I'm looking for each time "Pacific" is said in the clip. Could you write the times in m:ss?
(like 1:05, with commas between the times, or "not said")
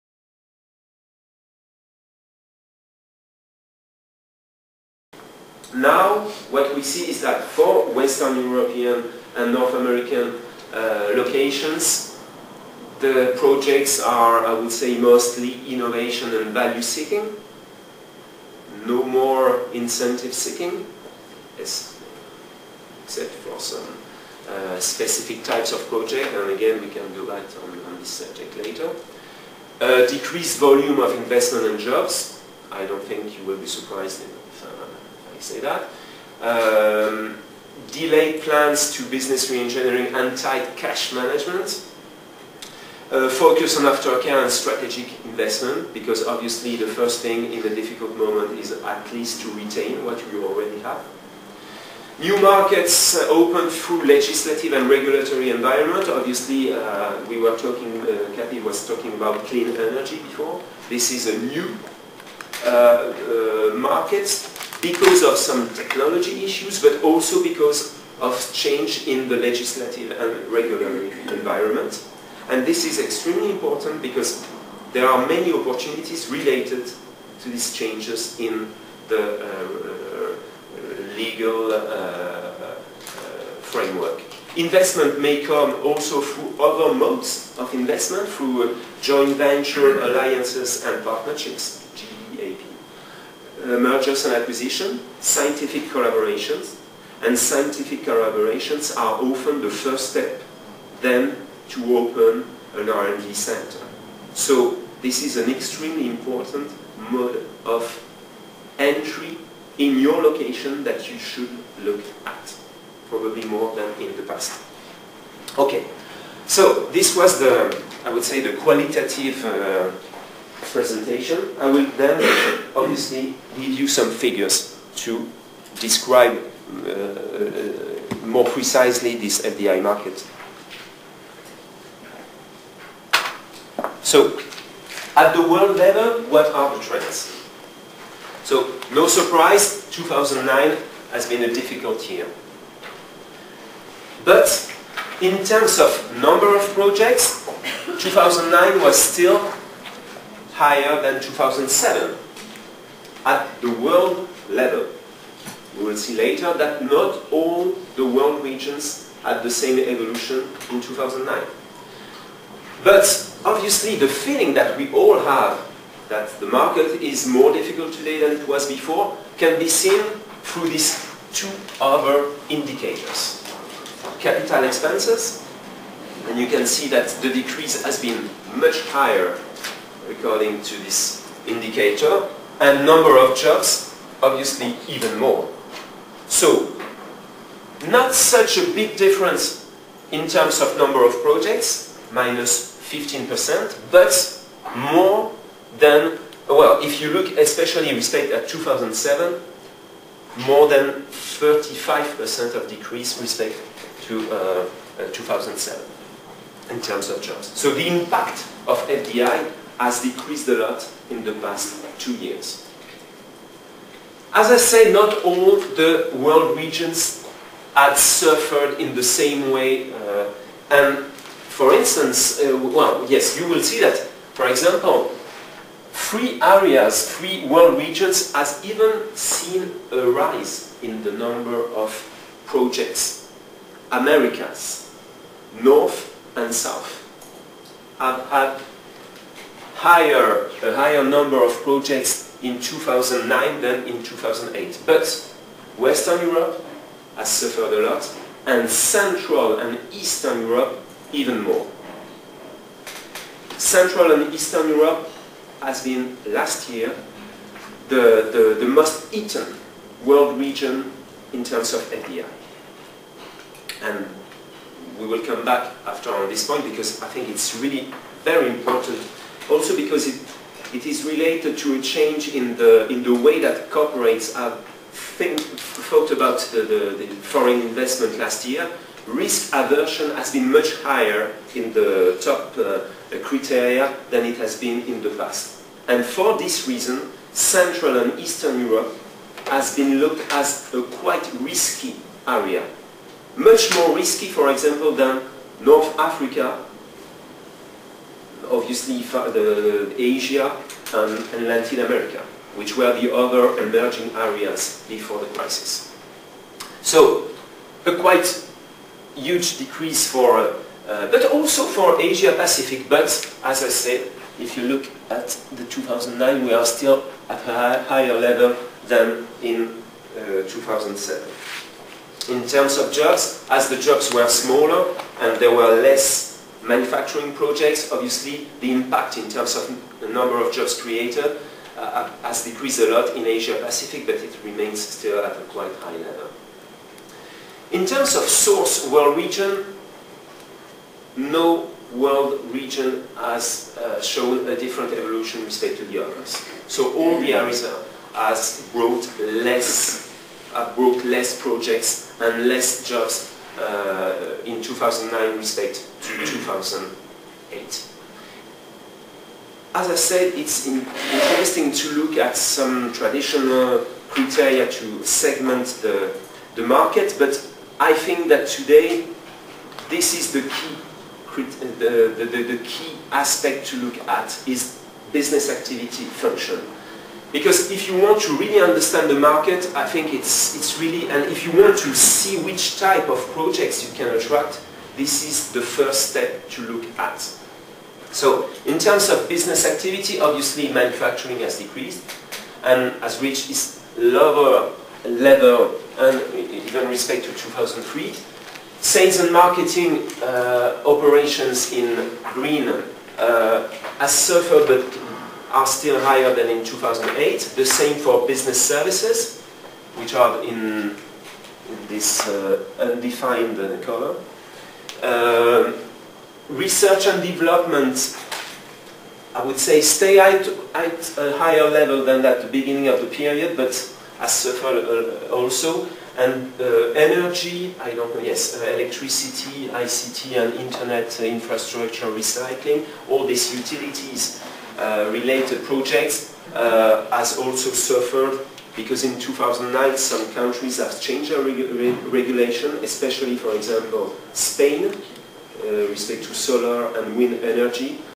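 5:12, 5:33.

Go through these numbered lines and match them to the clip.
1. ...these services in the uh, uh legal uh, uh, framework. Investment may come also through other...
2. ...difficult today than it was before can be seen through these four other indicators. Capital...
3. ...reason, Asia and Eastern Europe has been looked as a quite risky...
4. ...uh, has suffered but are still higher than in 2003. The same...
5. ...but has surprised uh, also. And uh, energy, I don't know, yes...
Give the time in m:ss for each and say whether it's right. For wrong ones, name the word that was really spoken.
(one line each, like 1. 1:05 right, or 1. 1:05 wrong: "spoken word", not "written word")
1. 1:17 wrong: "changes", not "services"
2. 2:47 wrong: "two", not "four"
3. 4:46 wrong: "Central", not "Asia"
4. 6:43 wrong: "2008", not "2003"
5. 7:03 wrong: "suffered", not "surprised".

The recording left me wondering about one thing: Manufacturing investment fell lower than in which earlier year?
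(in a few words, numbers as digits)
2003.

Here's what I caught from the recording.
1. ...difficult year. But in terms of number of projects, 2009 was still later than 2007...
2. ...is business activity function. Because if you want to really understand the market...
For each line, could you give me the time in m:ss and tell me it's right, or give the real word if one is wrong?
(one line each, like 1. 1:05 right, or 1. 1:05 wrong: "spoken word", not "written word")
1. 2:21 wrong: "higher", not "later"
2. 6:14 right.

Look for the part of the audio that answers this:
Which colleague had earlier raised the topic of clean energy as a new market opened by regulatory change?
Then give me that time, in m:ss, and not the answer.
0:58.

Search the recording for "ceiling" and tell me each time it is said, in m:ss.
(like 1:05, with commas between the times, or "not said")
not said.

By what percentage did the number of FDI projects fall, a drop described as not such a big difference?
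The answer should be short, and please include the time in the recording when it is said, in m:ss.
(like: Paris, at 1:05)
15%, at 3:12.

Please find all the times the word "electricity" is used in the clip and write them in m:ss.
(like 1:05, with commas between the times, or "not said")
7:08.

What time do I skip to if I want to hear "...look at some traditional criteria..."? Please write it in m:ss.
6:01.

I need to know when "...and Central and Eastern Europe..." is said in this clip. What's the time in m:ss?
4:08.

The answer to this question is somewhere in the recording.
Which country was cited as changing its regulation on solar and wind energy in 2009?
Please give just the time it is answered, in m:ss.
7:24.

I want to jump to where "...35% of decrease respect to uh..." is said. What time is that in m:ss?
3:21.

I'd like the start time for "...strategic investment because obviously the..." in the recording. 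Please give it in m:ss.
0:44.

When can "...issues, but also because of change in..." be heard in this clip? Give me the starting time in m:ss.
1:06.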